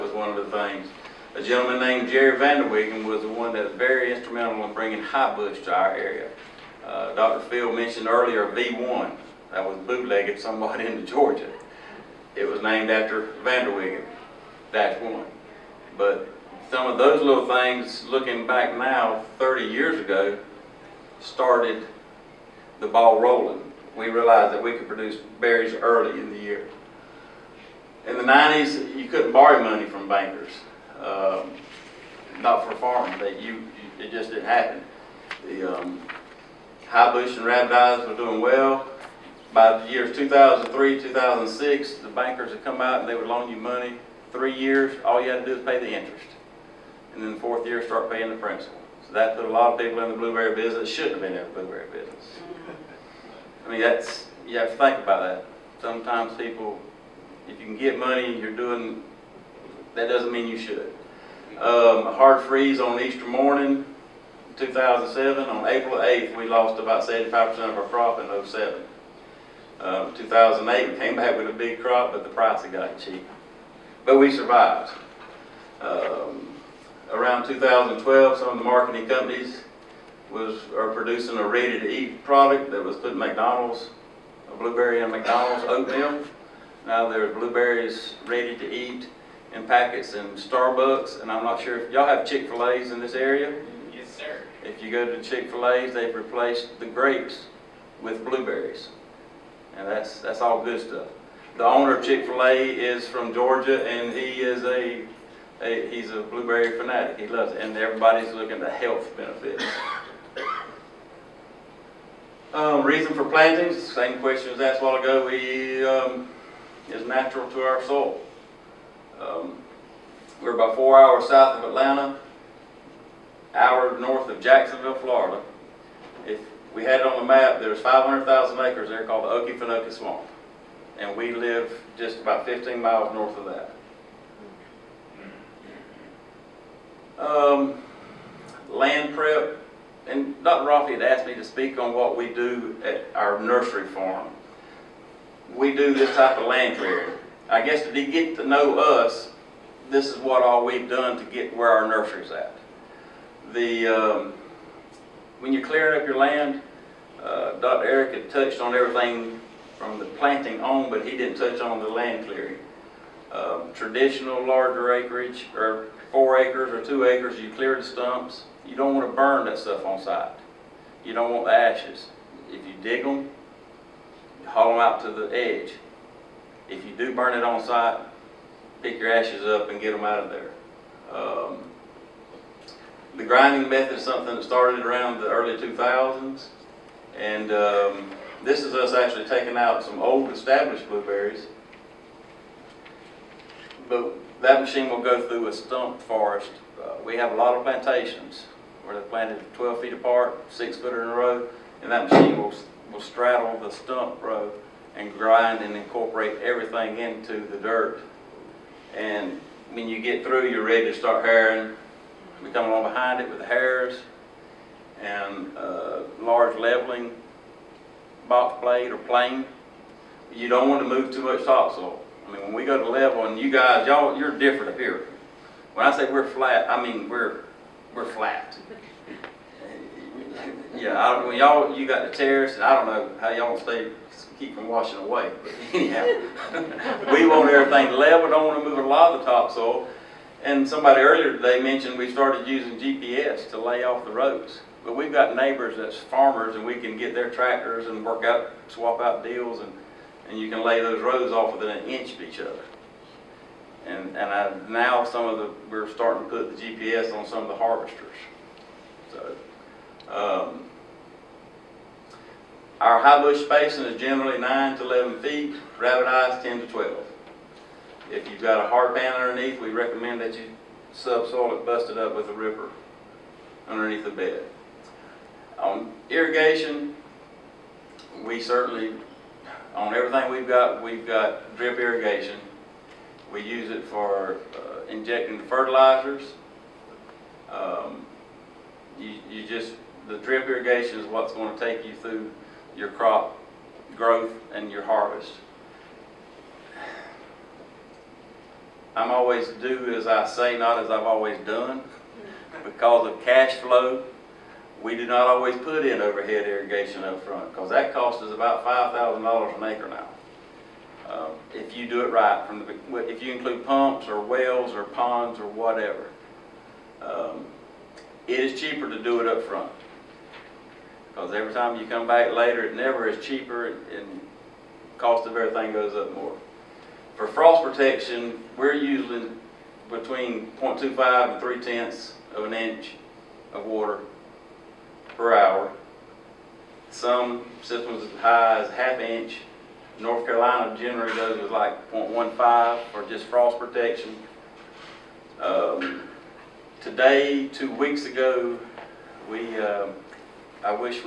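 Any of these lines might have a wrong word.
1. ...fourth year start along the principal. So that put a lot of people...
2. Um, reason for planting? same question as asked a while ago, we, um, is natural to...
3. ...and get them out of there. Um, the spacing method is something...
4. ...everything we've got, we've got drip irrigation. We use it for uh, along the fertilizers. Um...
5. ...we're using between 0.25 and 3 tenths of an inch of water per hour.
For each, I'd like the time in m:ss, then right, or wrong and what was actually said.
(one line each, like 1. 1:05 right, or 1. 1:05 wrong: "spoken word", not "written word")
1. 0:47 wrong: "paying", not "along"
2. 1:52 right
3. 2:59 wrong: "grinding", not "spacing"
4. 4:39 wrong: "injecting", not "along"
5. 5:28 right.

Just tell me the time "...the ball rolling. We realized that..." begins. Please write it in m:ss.
0:22.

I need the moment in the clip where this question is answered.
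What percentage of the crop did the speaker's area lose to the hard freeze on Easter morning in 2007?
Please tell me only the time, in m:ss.
1:07.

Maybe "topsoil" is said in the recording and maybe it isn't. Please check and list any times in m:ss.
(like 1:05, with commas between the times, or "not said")
3:41, 3:59.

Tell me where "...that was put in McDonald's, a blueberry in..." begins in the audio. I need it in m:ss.
1:22.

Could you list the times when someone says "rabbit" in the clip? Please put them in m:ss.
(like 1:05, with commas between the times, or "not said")
0:37, 4:25.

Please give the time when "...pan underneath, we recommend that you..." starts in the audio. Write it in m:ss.
4:28.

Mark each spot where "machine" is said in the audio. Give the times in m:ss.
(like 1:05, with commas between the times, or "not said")
3:14, 3:22.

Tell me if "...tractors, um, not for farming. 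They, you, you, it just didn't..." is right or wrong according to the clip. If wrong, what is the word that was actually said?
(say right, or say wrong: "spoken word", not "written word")
wrong: "bankers", not "tractors".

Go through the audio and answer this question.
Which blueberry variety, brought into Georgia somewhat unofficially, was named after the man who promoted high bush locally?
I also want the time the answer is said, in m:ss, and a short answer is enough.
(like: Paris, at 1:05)
V1, at 0:08.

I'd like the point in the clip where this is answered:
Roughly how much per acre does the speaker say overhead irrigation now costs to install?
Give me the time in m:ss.
5:08.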